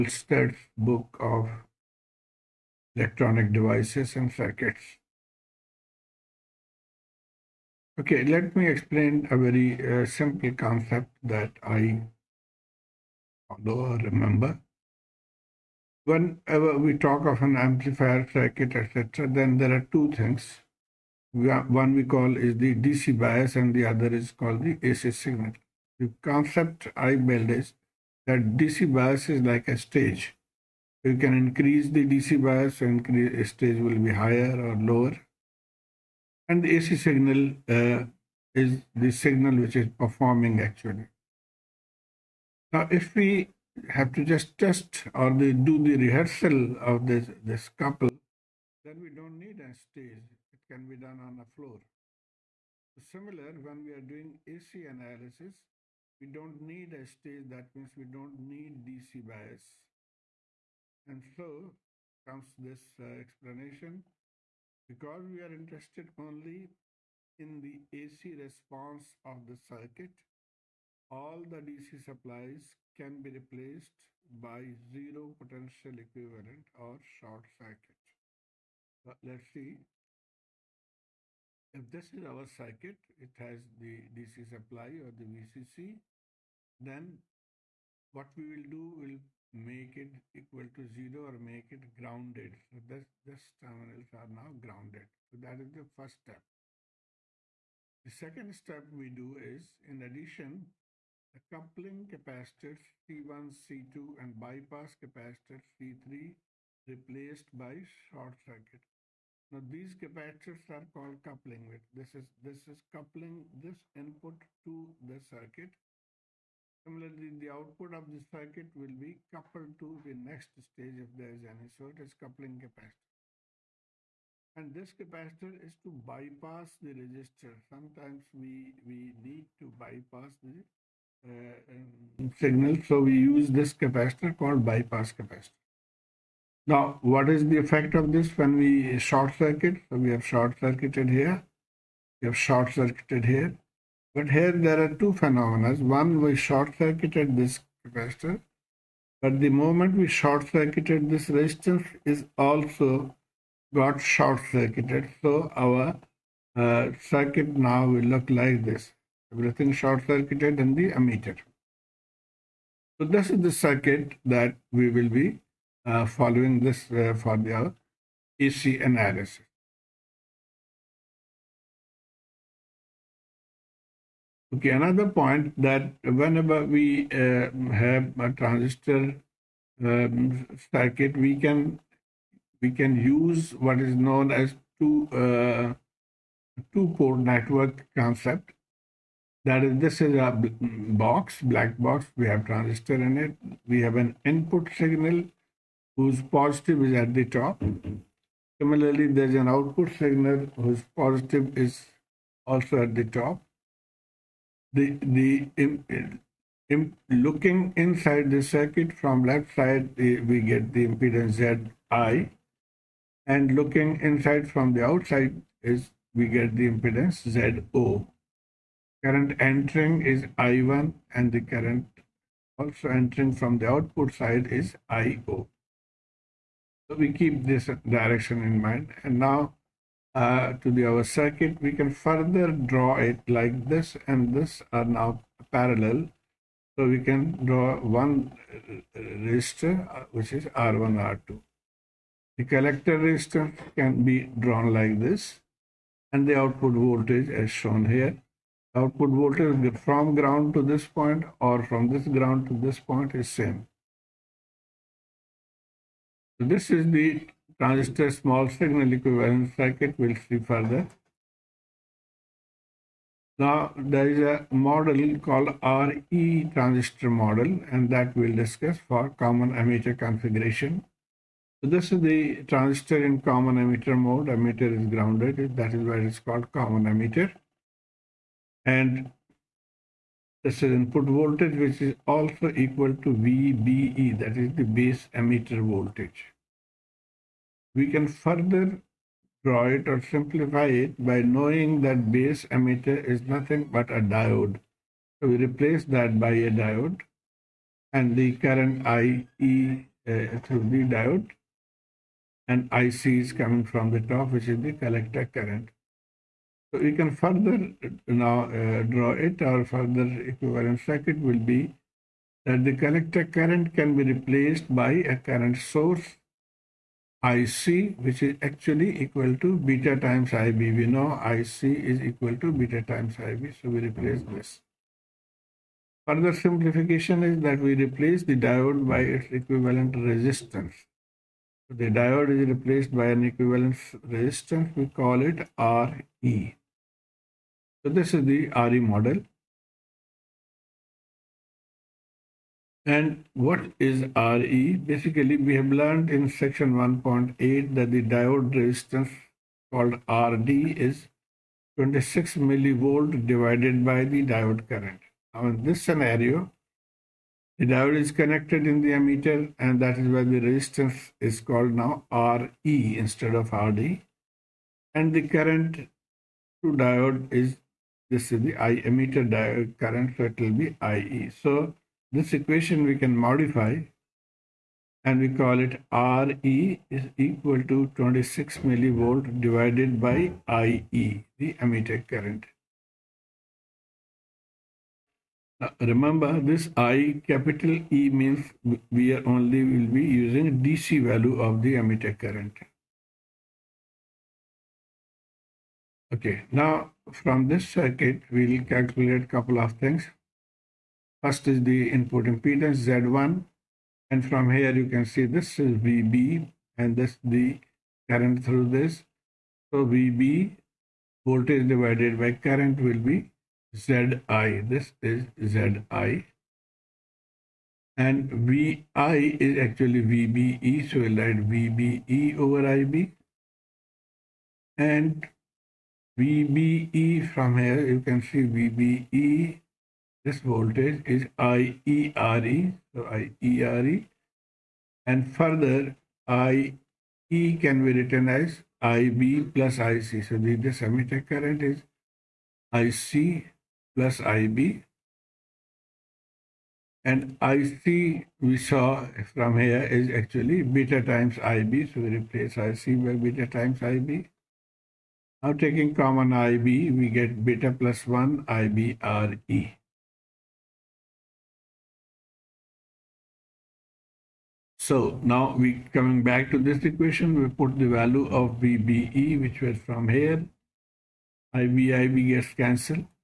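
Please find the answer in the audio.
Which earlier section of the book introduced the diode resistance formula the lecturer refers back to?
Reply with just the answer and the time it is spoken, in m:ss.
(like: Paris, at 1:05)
Section 1.8, at 5:46.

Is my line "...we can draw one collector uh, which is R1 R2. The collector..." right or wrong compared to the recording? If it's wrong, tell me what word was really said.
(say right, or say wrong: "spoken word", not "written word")
wrong: "resistor", not "collector".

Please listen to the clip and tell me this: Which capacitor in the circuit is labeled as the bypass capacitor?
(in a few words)
C3.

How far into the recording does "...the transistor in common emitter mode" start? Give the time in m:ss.
4:32.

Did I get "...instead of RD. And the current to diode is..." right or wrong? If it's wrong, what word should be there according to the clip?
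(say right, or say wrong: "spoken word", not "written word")
right.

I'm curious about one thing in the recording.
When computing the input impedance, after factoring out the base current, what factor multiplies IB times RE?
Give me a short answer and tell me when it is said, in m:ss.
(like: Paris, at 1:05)
Beta plus 1, at 7:37.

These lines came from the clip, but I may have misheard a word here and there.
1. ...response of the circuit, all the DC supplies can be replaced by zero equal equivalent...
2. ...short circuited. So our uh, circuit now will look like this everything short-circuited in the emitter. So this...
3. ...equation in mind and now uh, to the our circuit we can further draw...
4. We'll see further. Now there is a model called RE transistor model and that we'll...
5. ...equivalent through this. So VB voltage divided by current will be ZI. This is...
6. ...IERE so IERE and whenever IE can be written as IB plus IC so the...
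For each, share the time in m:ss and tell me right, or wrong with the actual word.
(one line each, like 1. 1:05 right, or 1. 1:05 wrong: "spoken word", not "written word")
1. 1:08 wrong: "potential", not "equal"
2. 2:34 right
3. 3:47 wrong: "direction", not "equation"
4. 4:19 right
5. 6:48 wrong: "current", not "equivalent"
6. 7:11 wrong: "further", not "whenever".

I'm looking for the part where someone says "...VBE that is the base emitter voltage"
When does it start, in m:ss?
4:43.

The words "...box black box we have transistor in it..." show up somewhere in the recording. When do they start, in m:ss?
3:11.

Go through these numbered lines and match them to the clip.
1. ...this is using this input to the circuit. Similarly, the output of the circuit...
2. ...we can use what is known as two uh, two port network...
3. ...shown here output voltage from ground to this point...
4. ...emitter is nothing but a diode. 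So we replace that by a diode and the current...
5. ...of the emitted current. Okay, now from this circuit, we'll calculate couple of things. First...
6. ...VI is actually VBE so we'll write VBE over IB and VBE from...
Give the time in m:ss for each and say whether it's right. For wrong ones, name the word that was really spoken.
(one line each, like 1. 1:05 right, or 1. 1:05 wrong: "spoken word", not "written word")
1. 1:52 wrong: "coupling", not "using"
2. 3:02 right
3. 4:07 right
4. 4:52 right
5. 6:31 right
6. 6:58 right.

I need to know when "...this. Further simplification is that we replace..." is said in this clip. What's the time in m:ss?
5:24.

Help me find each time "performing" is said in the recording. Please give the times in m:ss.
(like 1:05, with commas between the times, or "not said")
0:39.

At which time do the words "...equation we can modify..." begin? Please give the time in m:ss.
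6:12.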